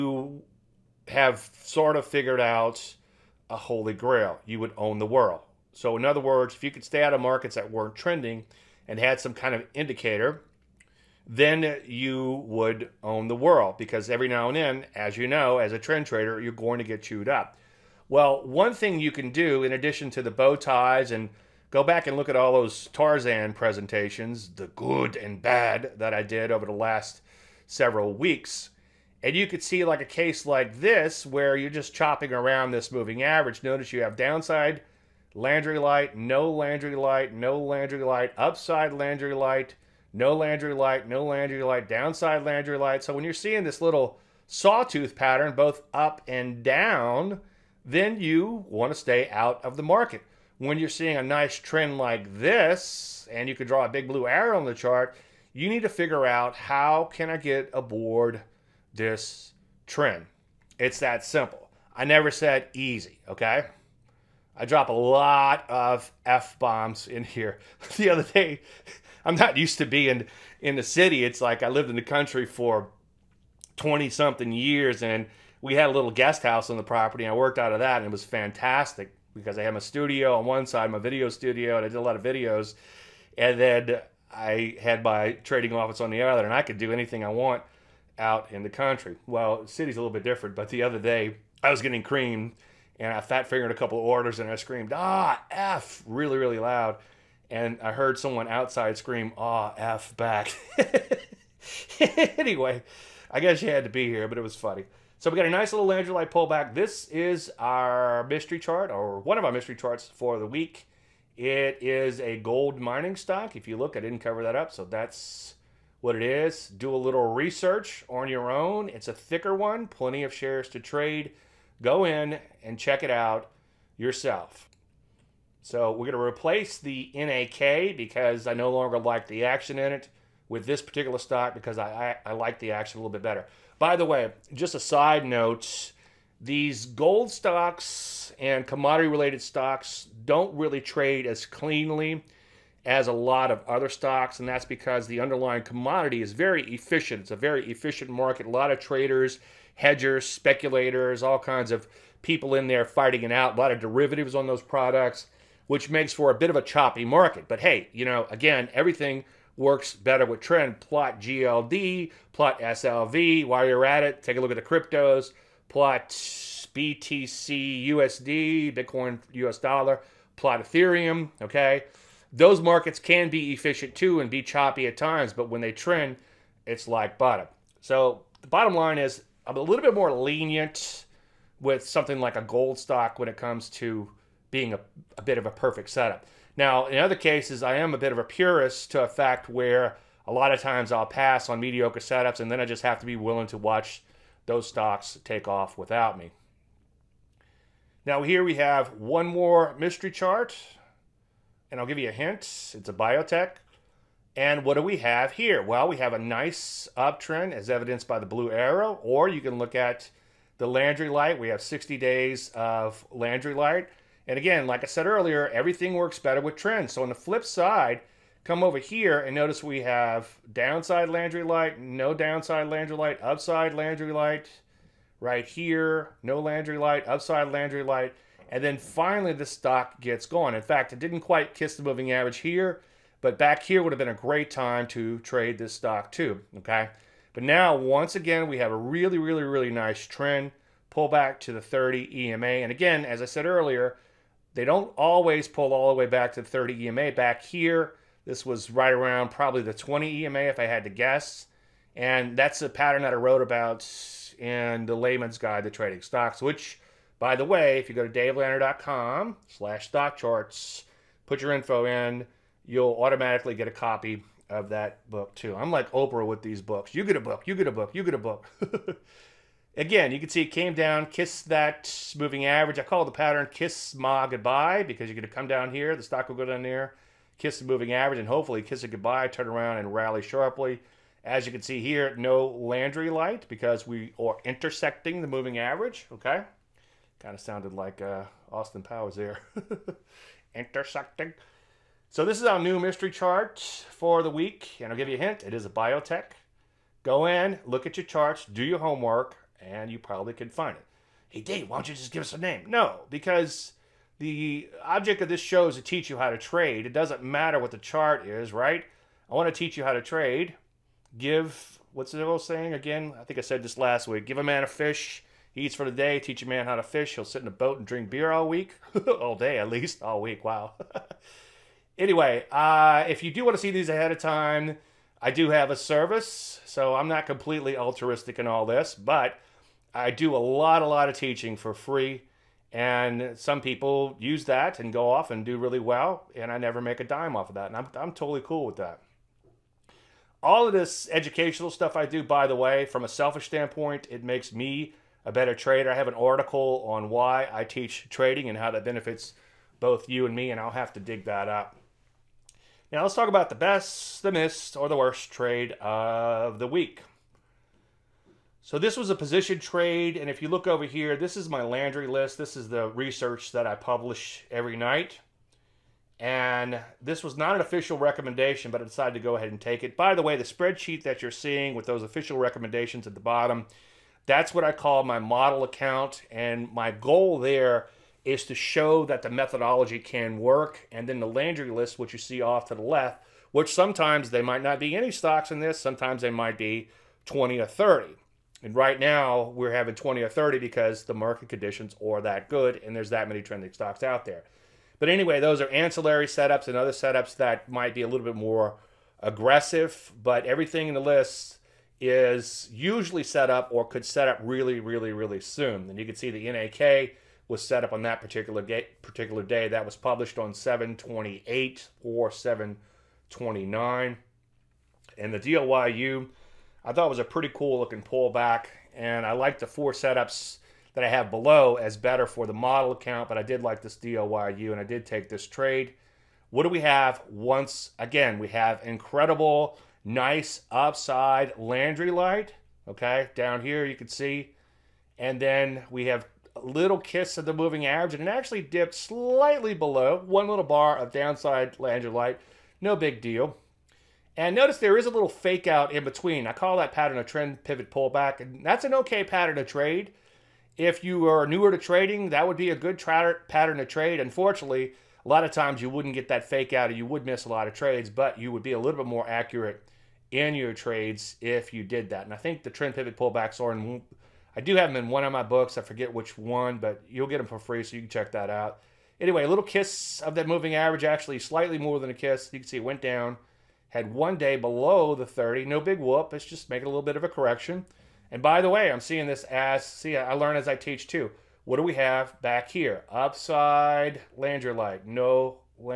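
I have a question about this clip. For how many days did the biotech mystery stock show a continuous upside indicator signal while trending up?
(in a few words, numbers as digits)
60.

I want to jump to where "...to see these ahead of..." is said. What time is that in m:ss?
5:23.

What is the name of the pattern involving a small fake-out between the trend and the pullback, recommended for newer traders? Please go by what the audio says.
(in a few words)
Trend pivot pullback.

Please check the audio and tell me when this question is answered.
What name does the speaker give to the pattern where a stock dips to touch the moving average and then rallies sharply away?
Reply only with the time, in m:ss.
4:33.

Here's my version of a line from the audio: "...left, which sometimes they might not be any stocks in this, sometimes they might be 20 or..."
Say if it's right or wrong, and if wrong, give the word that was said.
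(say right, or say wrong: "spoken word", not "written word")
right.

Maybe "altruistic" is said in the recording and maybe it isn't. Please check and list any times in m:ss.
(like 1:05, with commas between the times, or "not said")
5:27.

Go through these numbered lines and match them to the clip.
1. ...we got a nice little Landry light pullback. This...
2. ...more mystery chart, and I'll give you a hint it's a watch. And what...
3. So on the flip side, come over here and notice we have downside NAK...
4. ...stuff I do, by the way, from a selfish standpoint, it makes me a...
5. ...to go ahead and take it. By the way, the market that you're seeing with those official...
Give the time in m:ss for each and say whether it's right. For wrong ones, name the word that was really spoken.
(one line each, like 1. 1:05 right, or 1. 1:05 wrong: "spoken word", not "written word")
1. 1:45 right
2. 3:19 wrong: "biotech", not "watch"
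3. 3:36 wrong: "Landry", not "NAK"
4. 5:41 right
5. 6:09 wrong: "spreadsheet", not "market".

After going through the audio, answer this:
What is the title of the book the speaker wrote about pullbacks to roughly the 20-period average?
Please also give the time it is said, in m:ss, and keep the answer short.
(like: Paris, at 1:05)
The Layman's Guide to Trading Stocks, at 4:14.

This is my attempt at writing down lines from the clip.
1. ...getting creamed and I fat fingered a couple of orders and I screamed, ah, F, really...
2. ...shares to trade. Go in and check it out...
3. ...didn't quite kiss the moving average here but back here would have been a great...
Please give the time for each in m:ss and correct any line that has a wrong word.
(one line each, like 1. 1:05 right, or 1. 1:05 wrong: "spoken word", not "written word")
1. 1:31 right
2. 2:00 right
3. 3:50 right.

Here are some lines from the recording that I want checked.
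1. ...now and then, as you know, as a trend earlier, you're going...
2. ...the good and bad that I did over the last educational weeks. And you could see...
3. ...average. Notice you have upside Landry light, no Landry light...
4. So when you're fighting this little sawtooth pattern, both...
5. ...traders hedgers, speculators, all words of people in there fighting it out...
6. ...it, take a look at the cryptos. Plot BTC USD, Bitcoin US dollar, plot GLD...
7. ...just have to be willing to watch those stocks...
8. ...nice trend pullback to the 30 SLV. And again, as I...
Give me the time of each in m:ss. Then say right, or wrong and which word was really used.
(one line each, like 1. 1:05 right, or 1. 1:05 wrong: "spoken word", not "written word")
1. 0:14 wrong: "trader", not "earlier"
2. 0:24 wrong: "several", not "educational"
3. 0:33 wrong: "downside", not "upside"
4. 0:43 wrong: "seeing", not "fighting"
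5. 2:28 wrong: "kinds", not "words"
6. 2:44 wrong: "Ethereum", not "GLD"
7. 3:12 right
8. 3:59 wrong: "EMA", not "SLV".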